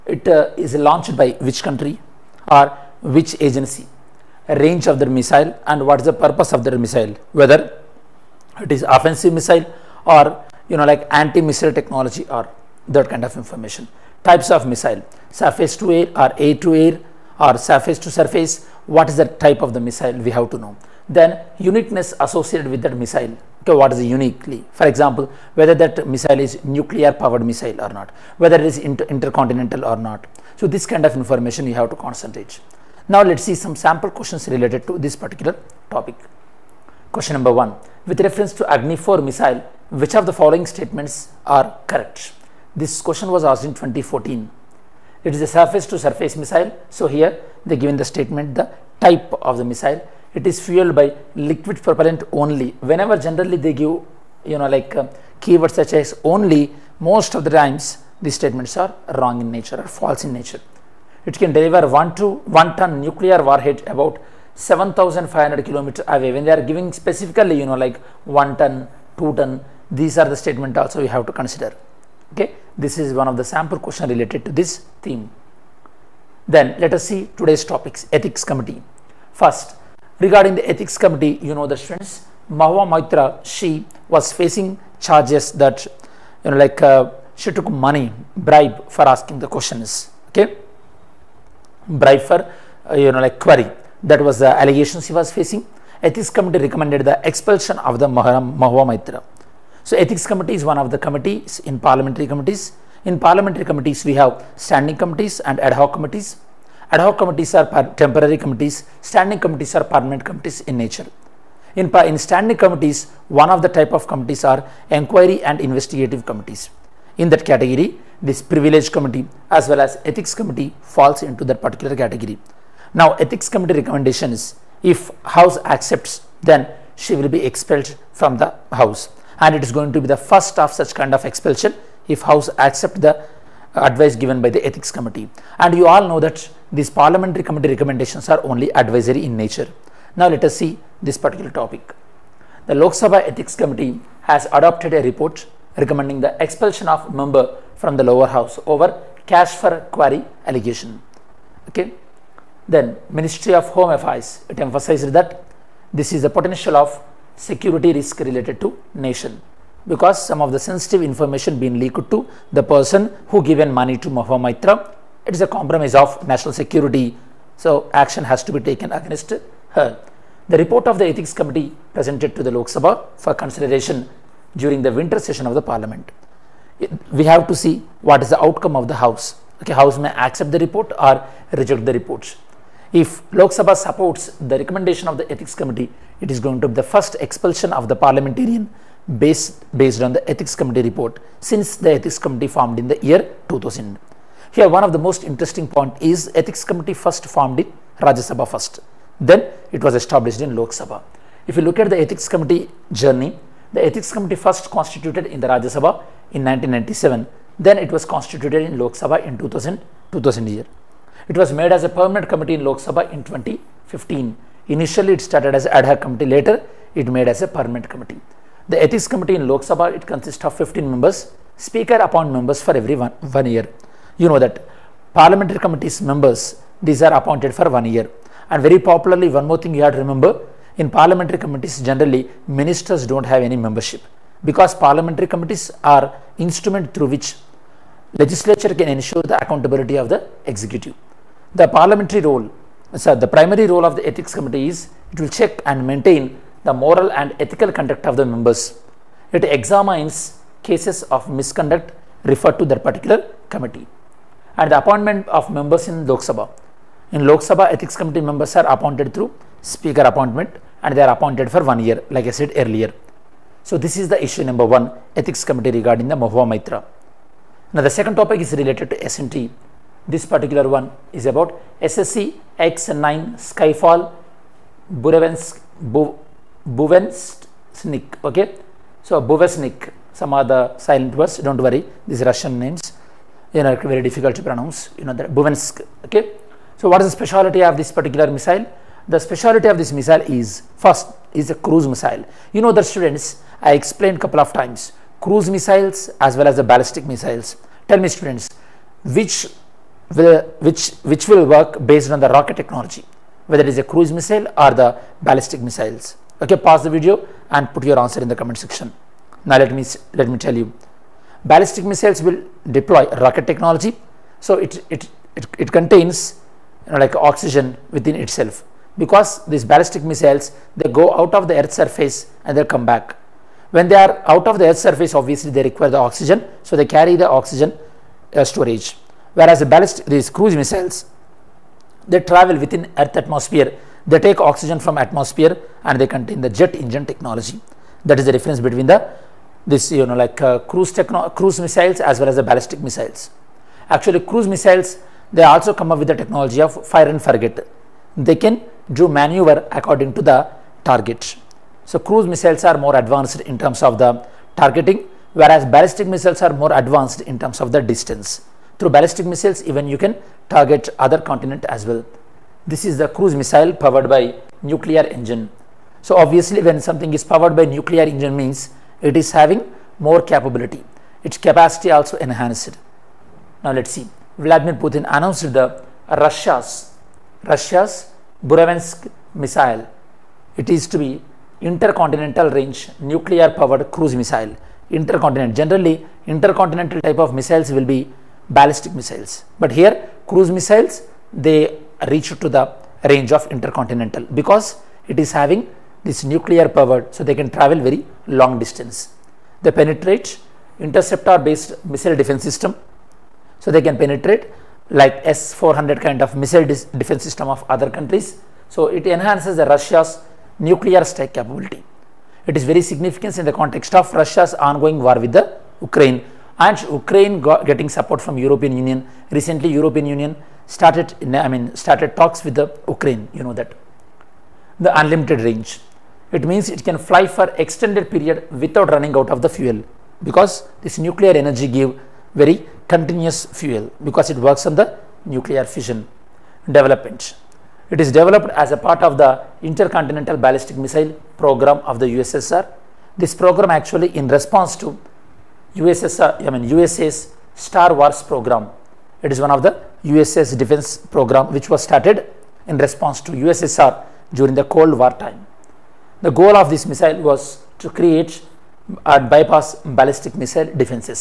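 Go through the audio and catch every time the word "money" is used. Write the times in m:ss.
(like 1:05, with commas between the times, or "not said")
1:27, 2:43.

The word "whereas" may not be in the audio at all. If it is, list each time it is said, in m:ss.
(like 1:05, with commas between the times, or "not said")
5:29, 5:55.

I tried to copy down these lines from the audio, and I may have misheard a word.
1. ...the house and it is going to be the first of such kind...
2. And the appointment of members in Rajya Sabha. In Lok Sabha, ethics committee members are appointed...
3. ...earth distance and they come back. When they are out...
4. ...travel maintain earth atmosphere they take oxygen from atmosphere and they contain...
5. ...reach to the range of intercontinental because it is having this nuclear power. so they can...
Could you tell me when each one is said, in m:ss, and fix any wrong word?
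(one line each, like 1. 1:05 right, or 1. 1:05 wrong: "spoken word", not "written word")
1. 2:08 right
2. 4:14 wrong: "Lok", not "Rajya"
3. 5:21 wrong: "surface", not "distance"
4. 5:32 wrong: "within", not "maintain"
5. 6:32 right.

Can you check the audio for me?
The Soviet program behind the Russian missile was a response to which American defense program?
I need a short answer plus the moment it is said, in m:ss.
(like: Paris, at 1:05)
Star Wars program, at 7:27.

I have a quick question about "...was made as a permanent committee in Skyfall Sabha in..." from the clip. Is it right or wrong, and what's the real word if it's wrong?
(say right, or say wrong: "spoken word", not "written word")
wrong: "Lok", not "Skyfall".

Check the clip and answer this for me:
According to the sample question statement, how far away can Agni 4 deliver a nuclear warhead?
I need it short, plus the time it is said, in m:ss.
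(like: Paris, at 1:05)
7500 kilometers, at 1:04.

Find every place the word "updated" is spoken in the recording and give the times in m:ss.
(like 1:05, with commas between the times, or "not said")
not said.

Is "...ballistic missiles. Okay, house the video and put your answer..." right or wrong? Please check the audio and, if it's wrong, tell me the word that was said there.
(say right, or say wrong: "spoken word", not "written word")
wrong: "pause", not "house".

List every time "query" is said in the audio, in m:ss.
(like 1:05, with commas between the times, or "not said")
1:33, 2:29.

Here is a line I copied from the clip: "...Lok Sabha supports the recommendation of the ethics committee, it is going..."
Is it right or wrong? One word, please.
right.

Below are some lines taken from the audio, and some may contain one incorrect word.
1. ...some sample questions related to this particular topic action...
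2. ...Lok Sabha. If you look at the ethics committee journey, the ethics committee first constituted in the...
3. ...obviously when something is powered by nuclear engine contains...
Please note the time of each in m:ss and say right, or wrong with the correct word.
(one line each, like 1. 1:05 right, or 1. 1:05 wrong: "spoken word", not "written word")
1. 0:33 wrong: "question", not "action"
2. 3:20 right
3. 6:06 wrong: "means", not "contains".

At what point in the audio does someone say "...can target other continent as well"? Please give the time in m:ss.
5:59.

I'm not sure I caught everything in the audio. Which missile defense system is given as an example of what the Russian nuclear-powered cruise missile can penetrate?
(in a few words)
S-400.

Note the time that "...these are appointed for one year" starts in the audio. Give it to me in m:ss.
3:46.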